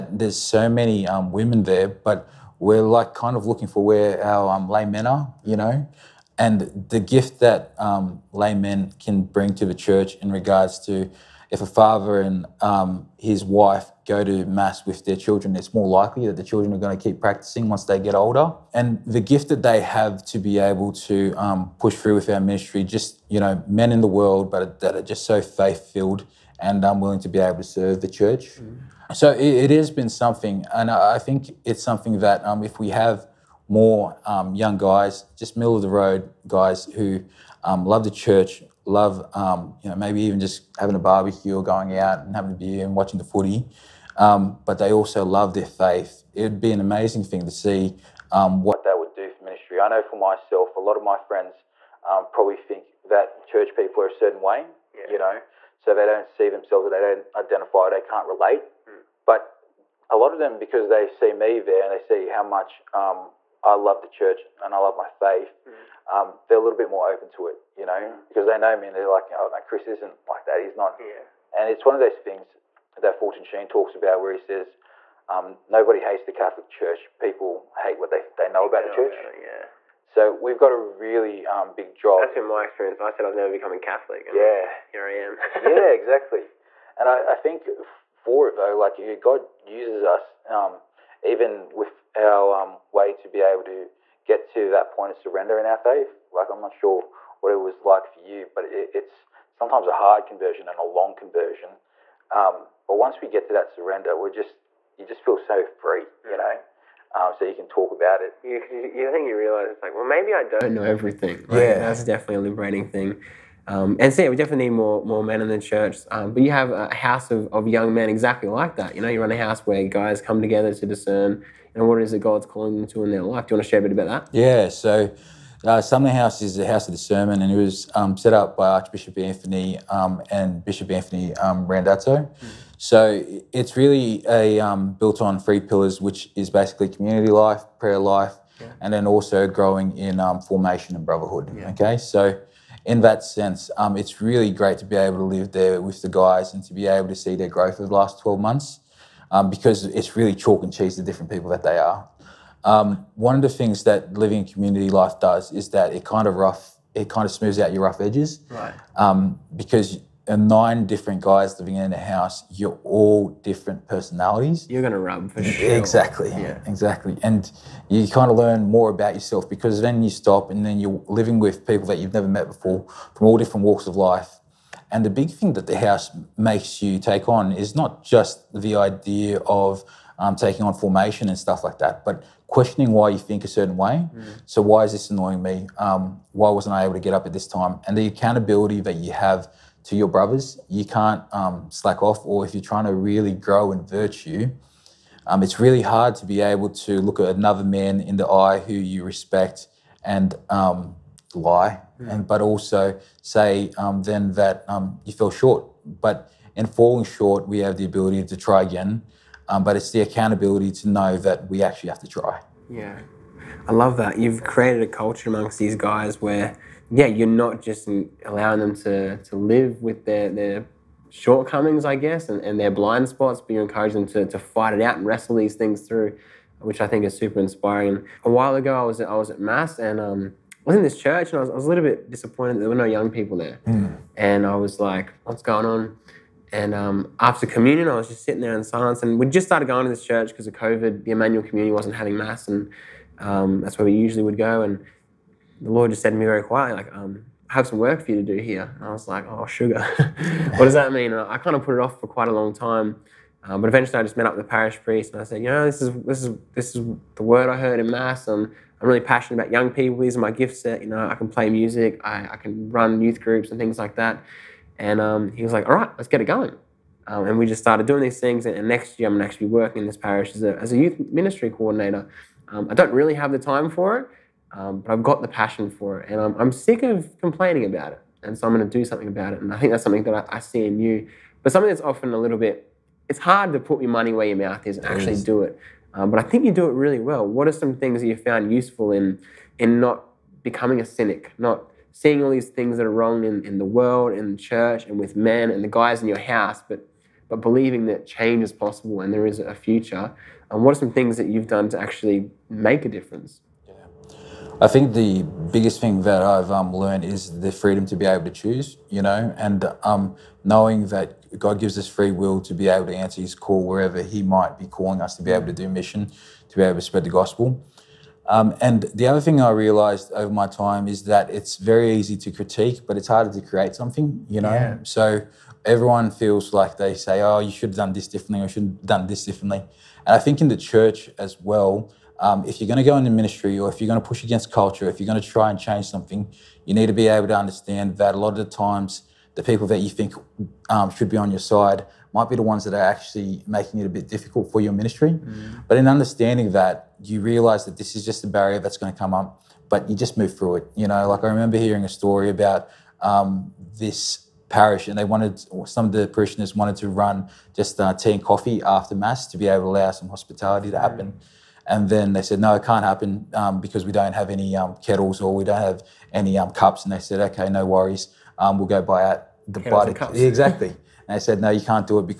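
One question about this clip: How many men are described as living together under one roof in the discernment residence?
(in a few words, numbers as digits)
9.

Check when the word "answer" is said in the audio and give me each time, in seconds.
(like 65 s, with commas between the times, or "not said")
312 s.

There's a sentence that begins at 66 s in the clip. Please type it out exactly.
um, they're a little bit more open to it, you know, mm.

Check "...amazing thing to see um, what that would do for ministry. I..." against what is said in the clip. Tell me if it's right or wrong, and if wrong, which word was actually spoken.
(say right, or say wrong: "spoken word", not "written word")
right.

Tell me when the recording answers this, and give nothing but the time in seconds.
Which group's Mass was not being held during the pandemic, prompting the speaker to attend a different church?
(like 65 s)
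241 s.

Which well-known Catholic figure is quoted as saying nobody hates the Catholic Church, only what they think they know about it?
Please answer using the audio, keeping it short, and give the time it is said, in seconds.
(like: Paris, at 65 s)
Fulton Sheen, at 73 s.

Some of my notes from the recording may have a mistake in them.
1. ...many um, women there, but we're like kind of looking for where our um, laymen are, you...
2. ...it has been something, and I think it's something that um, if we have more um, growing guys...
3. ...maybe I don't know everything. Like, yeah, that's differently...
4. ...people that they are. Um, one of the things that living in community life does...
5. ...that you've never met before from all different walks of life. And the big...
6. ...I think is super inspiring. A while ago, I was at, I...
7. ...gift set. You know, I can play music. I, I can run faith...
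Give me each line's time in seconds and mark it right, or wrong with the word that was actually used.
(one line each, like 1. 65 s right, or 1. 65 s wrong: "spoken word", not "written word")
1. 0 s right
2. 29 s wrong: "young", not "growing"
3. 110 s wrong: "definitely", not "differently"
4. 151 s right
5. 171 s right
6. 226 s right
7. 260 s wrong: "youth", not "faith".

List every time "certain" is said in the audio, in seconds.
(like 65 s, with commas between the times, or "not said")
54 s, 183 s.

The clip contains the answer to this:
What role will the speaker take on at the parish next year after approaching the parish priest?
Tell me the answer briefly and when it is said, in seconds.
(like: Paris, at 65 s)
Youth ministry coordinator, at 270 s.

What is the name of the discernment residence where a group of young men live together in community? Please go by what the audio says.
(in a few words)
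Sumner House.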